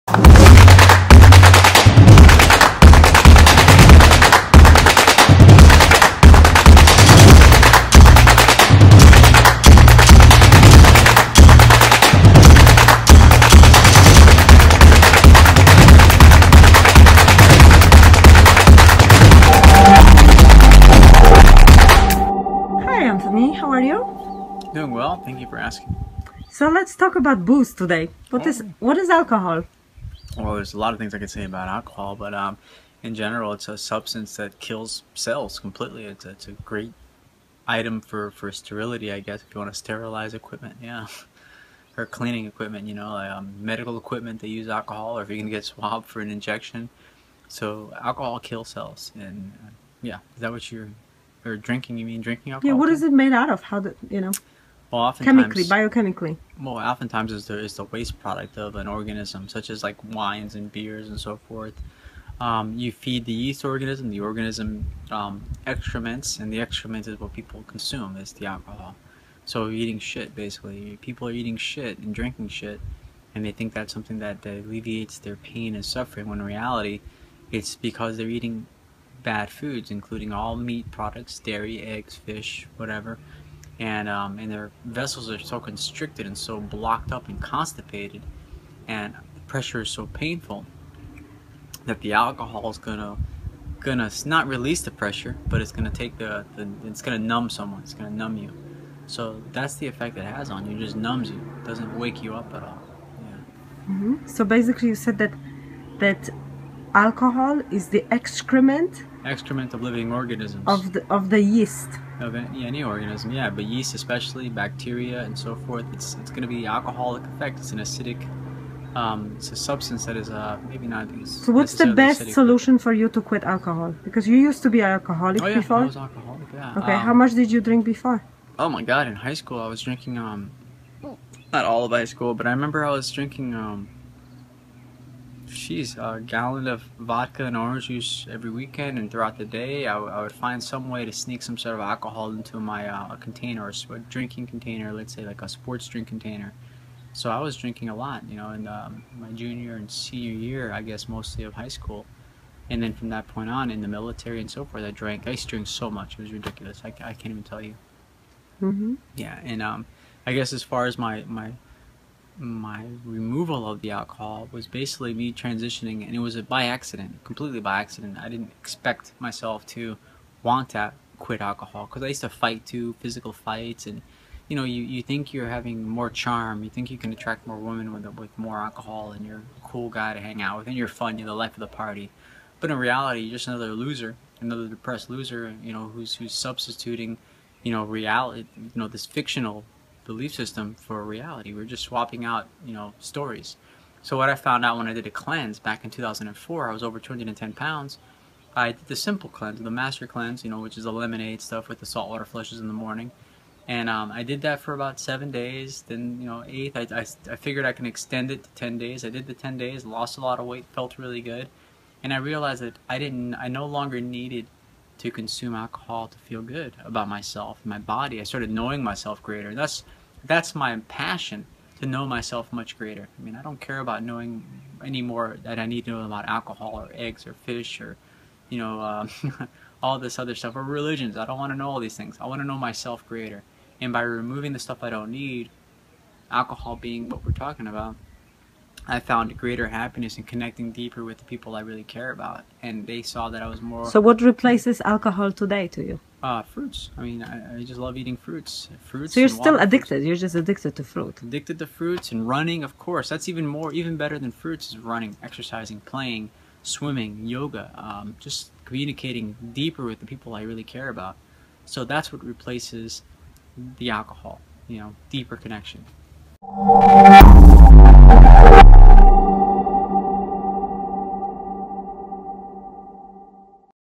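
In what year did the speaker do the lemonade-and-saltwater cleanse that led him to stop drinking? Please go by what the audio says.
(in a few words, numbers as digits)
2004.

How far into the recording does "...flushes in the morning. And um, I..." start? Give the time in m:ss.
3:22.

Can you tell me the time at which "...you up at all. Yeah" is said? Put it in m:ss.
1:42.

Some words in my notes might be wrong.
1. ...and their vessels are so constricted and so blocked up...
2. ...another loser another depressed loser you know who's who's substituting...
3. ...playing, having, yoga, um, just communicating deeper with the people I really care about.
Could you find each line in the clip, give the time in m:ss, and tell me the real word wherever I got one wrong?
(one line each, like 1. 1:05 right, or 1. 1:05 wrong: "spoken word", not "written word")
1. 1:24 right
2. 3:03 right
3. 4:15 wrong: "swimming", not "having".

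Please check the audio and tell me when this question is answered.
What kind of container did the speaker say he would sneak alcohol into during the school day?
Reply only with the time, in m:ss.
2:25.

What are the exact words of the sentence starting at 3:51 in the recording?
I don't want to know all these things.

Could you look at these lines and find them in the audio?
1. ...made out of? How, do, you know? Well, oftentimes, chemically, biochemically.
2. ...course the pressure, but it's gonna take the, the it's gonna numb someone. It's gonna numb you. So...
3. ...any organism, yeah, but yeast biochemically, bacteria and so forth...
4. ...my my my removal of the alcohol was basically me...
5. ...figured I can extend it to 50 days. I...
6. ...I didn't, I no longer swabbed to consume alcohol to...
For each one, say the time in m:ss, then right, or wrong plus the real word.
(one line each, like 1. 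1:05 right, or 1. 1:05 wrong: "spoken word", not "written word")
1. 0:53 right
2. 1:34 wrong: "release", not "course"
3. 1:52 wrong: "especially", not "biochemically"
4. 2:40 right
5. 3:27 wrong: "10", not "50"
6. 3:32 wrong: "needed", not "swabbed".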